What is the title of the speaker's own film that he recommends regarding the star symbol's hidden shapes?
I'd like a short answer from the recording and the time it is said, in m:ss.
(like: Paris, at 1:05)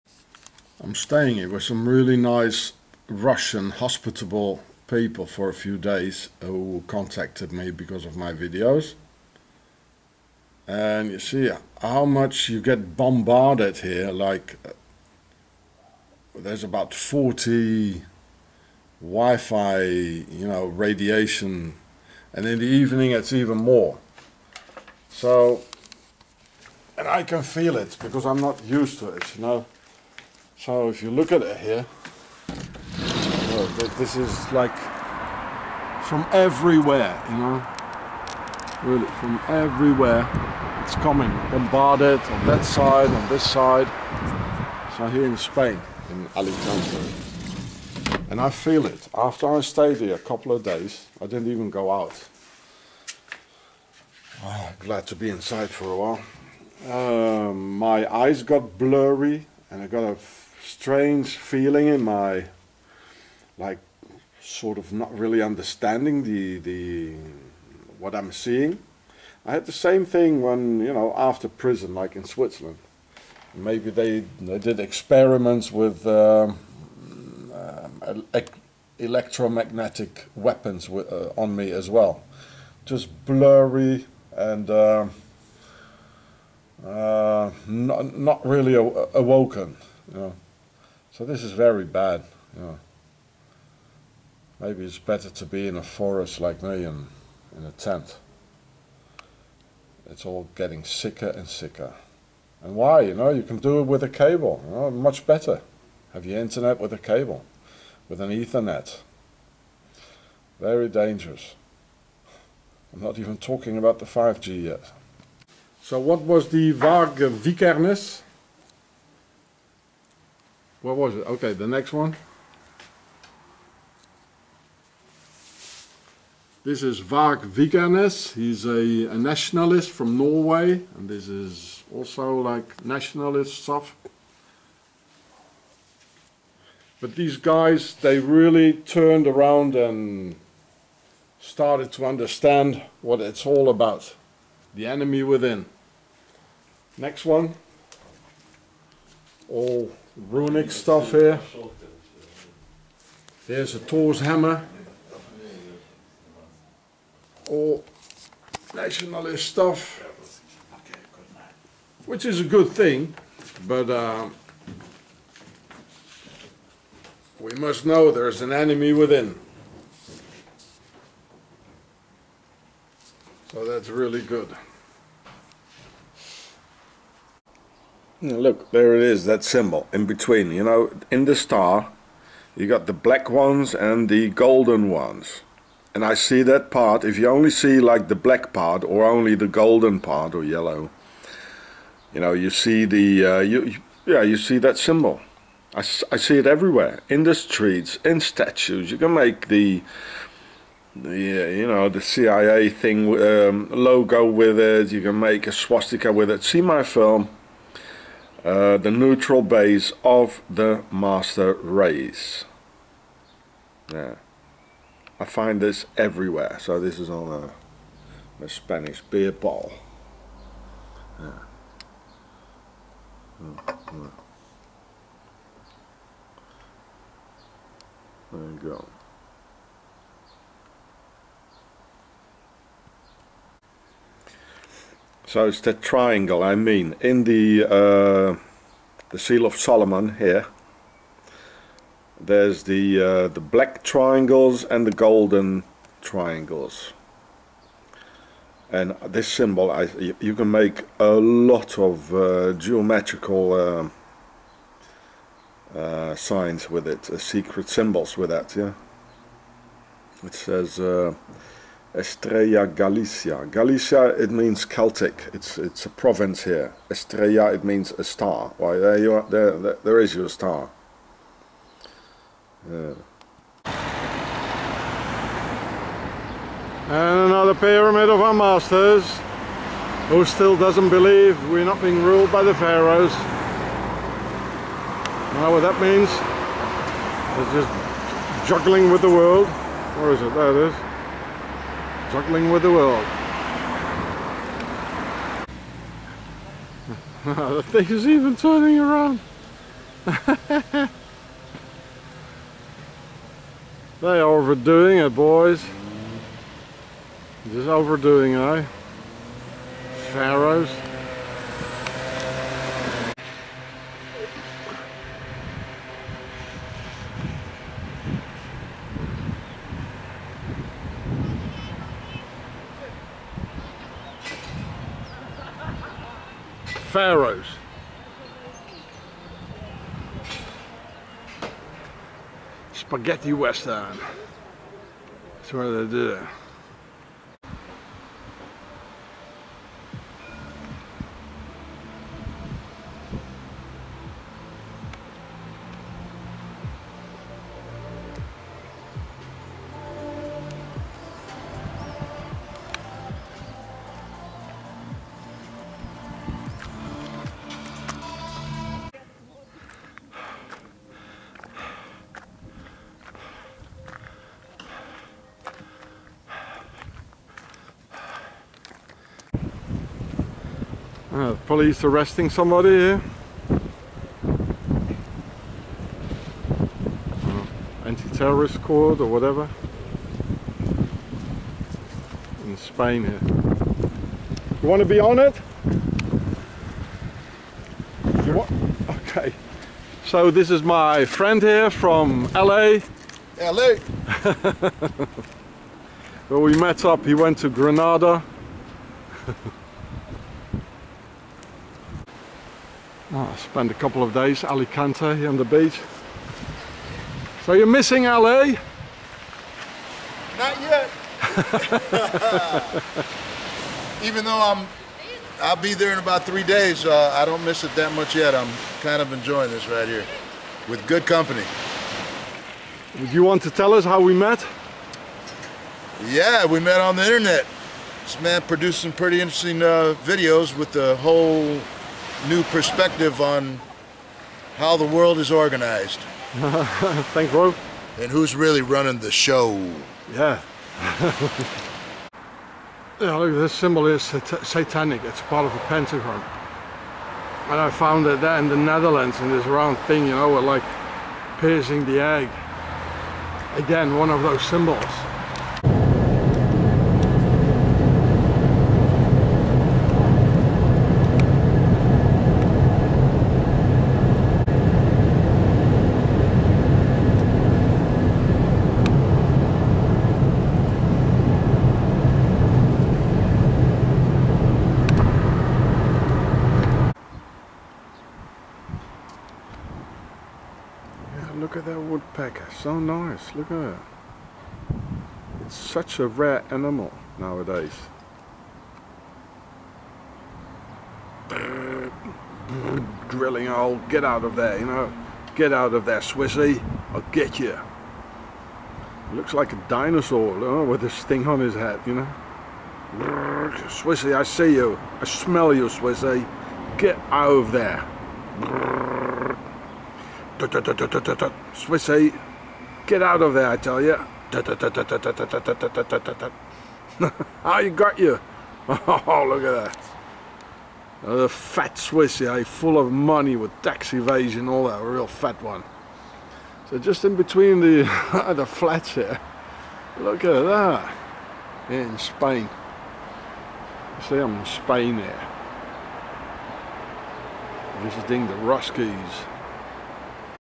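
The Neutral Base of the Master Race, at 3:28.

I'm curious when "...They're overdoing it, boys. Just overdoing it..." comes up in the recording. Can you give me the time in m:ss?
5:04.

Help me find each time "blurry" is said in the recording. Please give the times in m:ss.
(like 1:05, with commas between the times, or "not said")
0:58, 1:23.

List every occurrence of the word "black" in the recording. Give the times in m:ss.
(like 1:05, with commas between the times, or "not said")
3:02, 3:08, 4:03.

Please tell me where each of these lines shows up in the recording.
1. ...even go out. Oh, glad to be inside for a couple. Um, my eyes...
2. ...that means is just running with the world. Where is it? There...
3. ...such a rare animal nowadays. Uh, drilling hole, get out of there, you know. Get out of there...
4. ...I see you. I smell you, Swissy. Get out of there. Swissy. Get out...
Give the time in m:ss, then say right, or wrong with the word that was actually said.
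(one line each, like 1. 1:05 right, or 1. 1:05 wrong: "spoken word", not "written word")
1. 0:51 wrong: "while", not "couple"
2. 4:45 wrong: "juggling", not "running"
3. 8:05 right
4. 8:24 right.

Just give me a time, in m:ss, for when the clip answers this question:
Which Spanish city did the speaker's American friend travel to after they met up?
6:37.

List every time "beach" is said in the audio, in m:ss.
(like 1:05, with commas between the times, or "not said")
6:45.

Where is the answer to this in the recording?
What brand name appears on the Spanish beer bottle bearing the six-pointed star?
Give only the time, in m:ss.
4:21.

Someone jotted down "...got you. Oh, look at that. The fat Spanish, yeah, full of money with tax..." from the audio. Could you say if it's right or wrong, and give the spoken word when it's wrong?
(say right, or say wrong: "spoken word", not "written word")
wrong: "Swiss", not "Spanish".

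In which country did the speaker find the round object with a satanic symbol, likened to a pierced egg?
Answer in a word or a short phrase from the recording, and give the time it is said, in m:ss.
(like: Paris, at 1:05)
Netherlands, at 7:28.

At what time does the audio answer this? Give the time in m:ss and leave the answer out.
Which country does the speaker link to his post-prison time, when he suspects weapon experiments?
1:12.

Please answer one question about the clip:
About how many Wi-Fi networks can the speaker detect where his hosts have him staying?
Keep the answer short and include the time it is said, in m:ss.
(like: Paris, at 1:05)
40, at 0:16.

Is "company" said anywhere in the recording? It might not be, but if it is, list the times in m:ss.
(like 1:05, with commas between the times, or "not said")
7:01.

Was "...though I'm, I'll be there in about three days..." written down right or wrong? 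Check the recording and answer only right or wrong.
right.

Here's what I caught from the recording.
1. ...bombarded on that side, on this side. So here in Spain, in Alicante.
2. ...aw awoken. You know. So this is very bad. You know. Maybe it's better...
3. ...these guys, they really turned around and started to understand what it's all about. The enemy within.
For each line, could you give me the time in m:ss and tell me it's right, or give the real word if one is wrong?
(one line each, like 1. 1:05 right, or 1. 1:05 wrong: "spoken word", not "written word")
1. 0:41 right
2. 1:28 right
3. 2:17 right.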